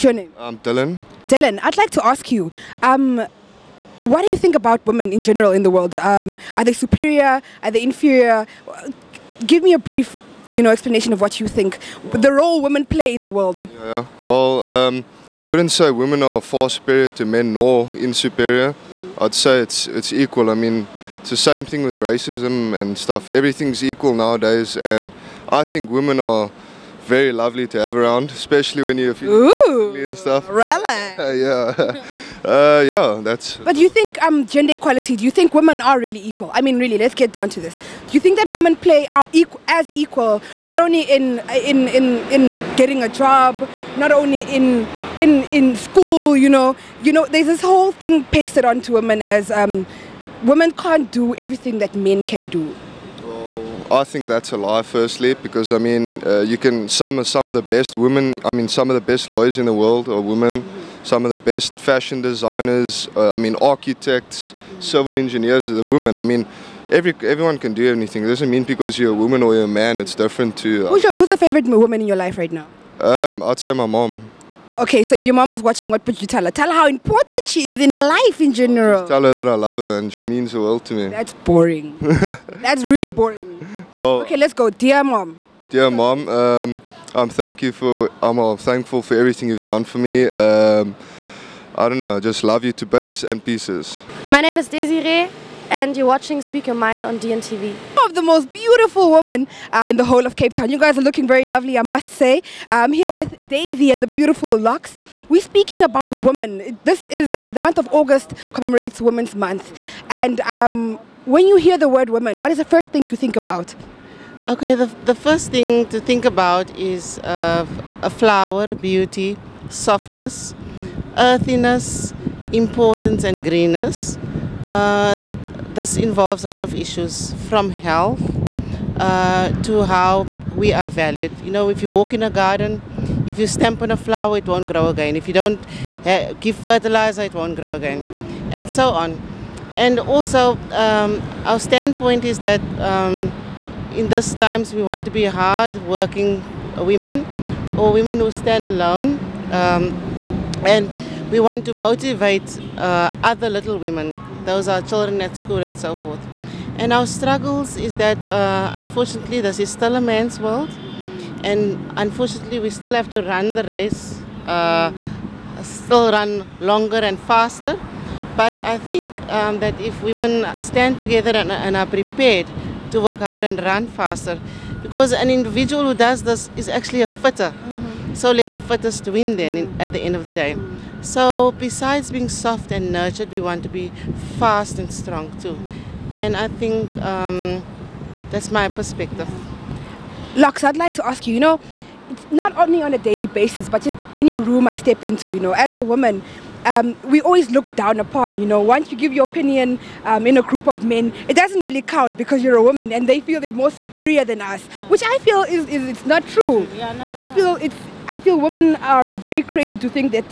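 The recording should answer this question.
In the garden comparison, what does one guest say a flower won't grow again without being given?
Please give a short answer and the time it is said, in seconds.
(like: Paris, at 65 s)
Fertilizer, at 136 s.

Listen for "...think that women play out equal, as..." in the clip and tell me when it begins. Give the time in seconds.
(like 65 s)
38 s.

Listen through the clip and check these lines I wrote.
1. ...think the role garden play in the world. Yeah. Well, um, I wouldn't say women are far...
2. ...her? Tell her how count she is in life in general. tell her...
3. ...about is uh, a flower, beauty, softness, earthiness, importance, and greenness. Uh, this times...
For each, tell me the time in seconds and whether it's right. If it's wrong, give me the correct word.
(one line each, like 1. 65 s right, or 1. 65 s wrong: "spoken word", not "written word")
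1. 11 s wrong: "women", not "garden"
2. 76 s wrong: "important", not "count"
3. 116 s wrong: "involves", not "times".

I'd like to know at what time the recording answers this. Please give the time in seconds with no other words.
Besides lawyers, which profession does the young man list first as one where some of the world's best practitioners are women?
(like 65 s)
61 s.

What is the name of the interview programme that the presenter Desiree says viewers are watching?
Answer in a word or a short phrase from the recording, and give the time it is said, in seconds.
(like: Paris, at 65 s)
Speak Your Mind, at 96 s.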